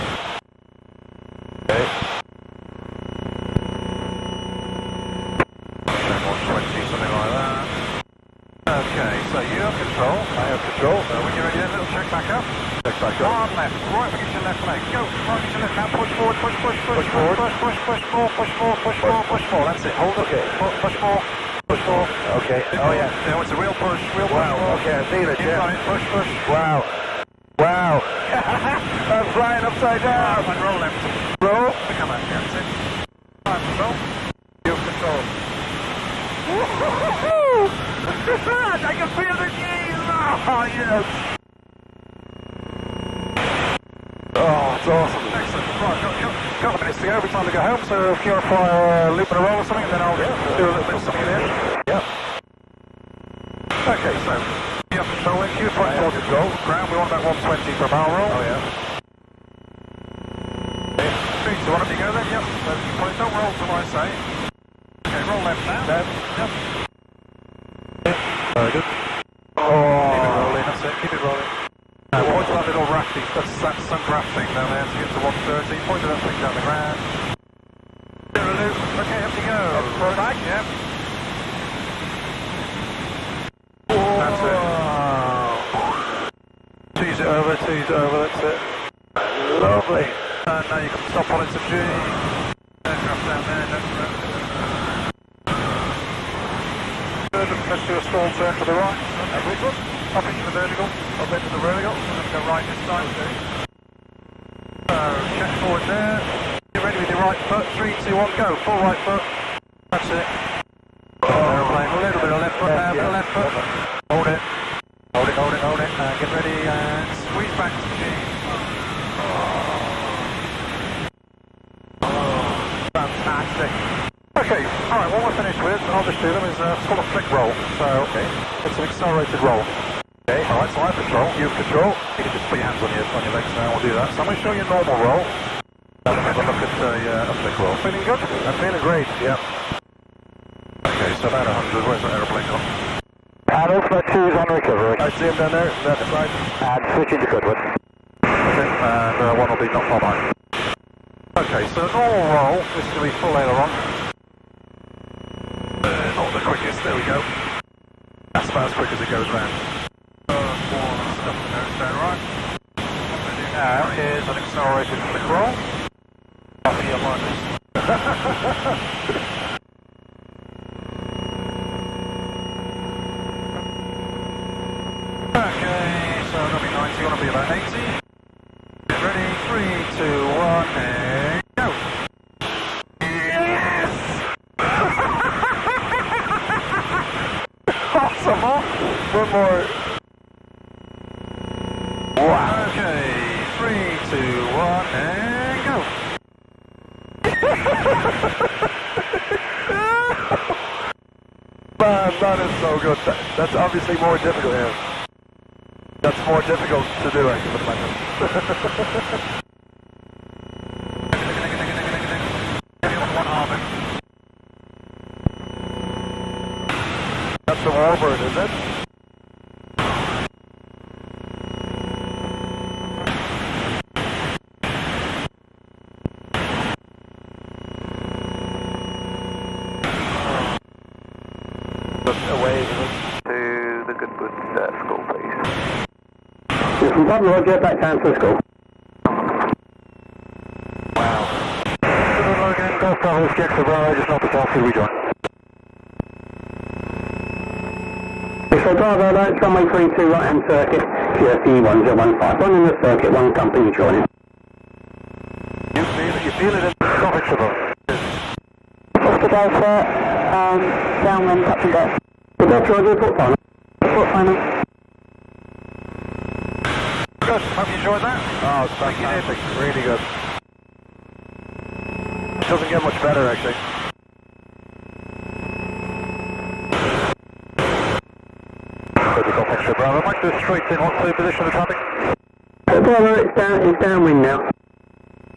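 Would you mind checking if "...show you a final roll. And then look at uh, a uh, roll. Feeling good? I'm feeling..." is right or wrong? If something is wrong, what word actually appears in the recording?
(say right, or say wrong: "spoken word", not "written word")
wrong: "normal", not "final".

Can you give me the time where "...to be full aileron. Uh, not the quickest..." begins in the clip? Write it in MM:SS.
02:33.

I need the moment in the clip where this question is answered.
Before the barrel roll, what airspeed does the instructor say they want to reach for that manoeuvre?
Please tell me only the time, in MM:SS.
00:57.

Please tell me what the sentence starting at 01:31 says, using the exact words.
Aircraft down there, don't Let's do a small turn to the right.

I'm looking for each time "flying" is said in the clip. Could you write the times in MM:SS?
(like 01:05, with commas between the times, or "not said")
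00:29.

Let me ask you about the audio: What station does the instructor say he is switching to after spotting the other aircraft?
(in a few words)
Goodwood.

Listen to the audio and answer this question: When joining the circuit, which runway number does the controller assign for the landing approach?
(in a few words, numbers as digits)
32.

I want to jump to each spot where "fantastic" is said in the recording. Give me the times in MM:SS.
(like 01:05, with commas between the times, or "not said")
02:02, 04:28.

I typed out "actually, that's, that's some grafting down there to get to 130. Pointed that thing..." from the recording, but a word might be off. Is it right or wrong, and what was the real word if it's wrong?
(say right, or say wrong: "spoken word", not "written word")
right.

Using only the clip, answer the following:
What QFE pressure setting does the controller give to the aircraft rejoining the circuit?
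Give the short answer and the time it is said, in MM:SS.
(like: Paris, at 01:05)
1015, at 04:11.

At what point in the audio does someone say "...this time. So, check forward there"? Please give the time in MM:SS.
01:42.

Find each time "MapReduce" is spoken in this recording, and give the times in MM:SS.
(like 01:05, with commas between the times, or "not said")
not said.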